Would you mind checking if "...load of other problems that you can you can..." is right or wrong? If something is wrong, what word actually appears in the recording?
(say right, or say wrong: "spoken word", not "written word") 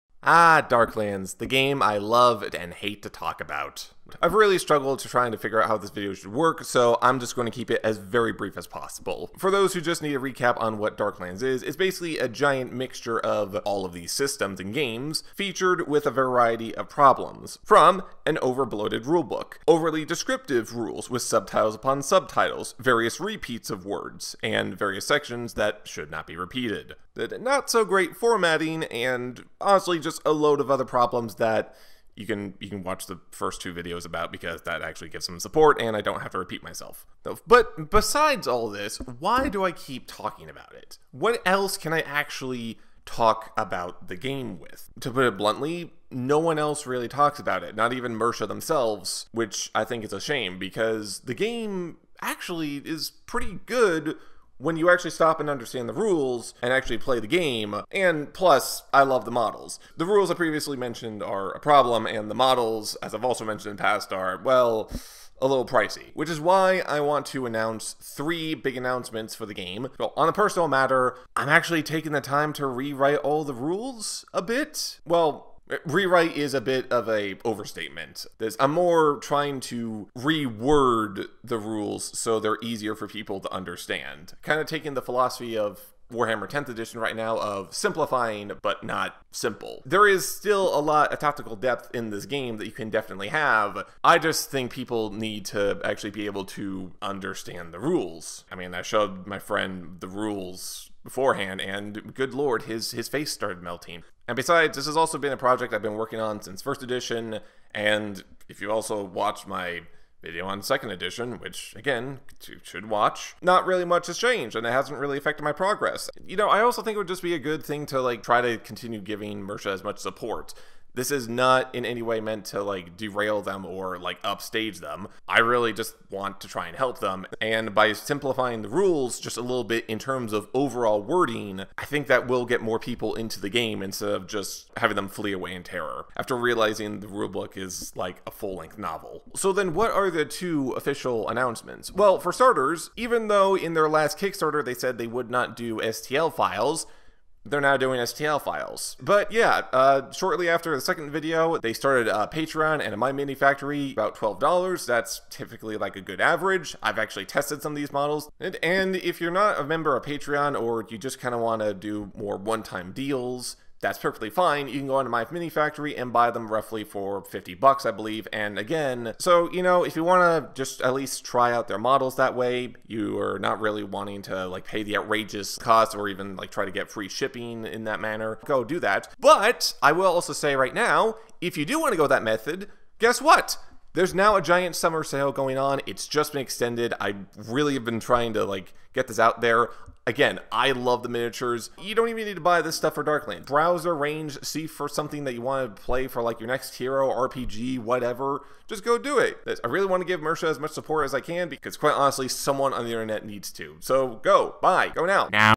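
right.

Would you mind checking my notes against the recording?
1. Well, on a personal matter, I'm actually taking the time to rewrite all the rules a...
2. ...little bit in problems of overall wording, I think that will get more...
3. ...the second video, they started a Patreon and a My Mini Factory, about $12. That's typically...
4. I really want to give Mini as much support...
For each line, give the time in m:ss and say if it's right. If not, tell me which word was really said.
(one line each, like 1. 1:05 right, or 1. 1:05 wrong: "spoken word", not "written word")
1. 1:09 right
2. 2:09 wrong: "terms", not "problems"
3. 2:30 right
4. 3:19 wrong: "Mierce", not "Mini".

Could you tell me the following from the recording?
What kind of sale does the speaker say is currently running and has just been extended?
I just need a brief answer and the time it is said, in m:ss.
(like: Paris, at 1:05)
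summer sale, at 3:04.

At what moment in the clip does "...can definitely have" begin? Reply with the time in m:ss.
1:32.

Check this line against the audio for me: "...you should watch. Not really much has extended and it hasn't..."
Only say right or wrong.
wrong.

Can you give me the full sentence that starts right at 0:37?
But besides all this, why do I keep talking about it?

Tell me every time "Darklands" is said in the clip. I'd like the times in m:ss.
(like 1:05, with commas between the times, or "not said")
0:00, 0:10, 3:13.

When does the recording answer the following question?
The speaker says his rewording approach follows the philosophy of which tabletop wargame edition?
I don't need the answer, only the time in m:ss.
1:26.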